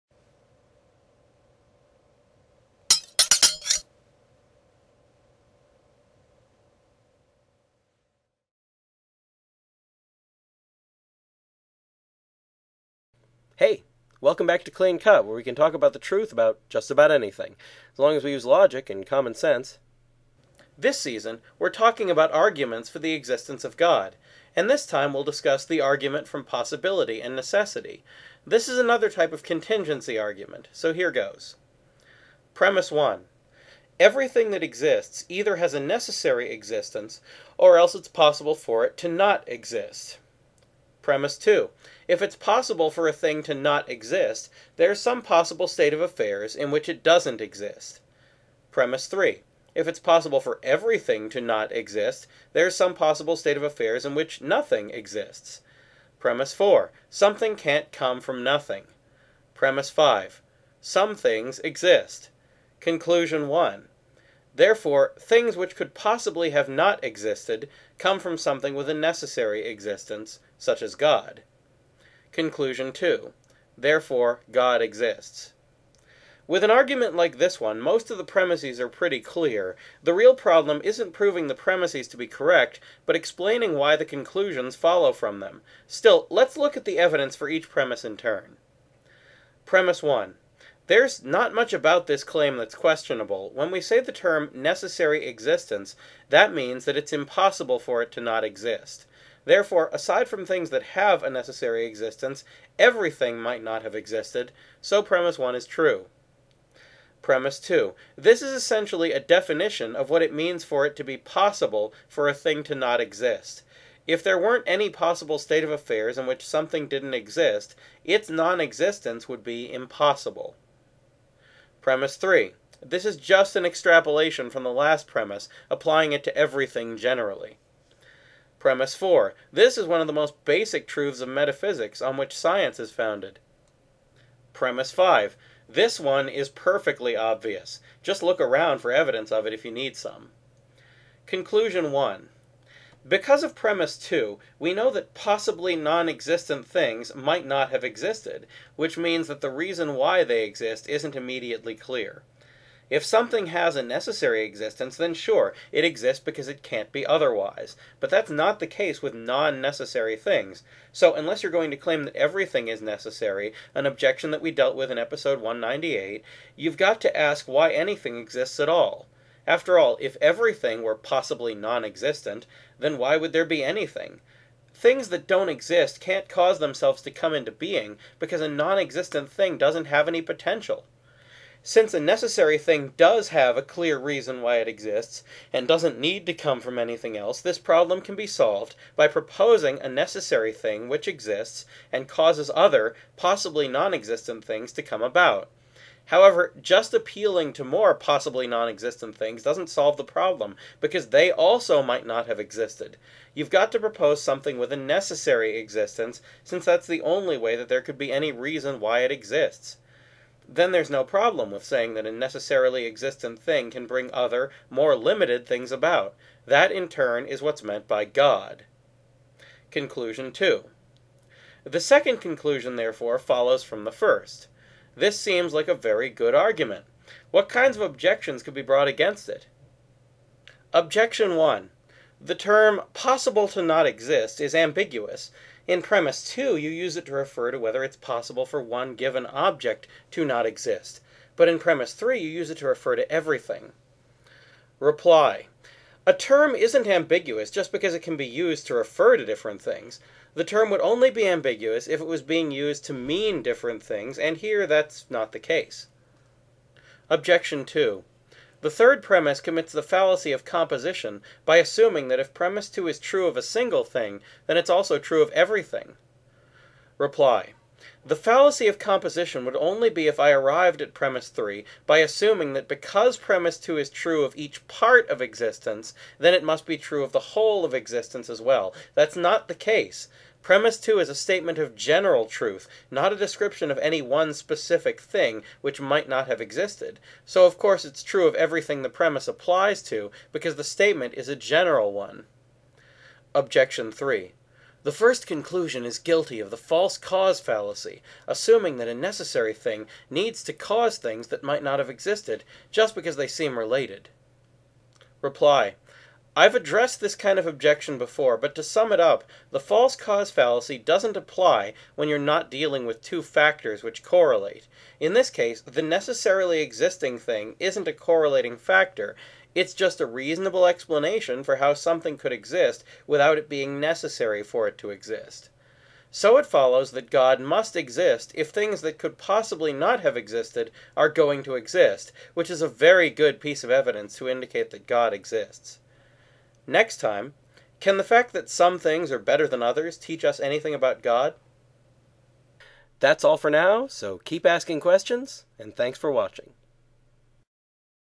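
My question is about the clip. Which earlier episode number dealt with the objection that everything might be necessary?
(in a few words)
198.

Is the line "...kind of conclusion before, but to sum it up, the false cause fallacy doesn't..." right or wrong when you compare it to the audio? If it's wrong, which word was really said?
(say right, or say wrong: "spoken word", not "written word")
wrong: "objection", not "conclusion".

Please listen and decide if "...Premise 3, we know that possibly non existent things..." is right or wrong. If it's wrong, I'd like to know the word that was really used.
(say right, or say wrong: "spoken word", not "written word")
wrong: "2", not "3".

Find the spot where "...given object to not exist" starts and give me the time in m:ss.
3:58.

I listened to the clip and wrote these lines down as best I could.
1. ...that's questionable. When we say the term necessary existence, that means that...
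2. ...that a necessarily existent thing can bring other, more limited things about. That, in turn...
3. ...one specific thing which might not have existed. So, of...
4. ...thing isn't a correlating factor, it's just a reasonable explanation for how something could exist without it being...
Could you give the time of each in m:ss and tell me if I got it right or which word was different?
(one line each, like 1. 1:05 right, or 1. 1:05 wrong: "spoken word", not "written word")
1. 1:32 right
2. 3:31 right
3. 4:44 right
4. 5:17 right.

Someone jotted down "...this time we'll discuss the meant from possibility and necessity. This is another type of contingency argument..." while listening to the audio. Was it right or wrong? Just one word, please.
wrong.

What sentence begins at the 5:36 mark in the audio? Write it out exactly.
Next time, can the fact that some things are better than others teach us anything about God?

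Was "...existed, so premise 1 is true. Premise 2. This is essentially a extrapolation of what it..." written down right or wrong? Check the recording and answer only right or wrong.
wrong.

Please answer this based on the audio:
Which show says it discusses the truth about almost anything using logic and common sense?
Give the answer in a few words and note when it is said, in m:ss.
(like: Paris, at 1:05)
Clean Cut, at 0:14.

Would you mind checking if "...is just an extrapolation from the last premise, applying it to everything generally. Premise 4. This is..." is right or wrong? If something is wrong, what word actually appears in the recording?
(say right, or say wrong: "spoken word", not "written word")
right.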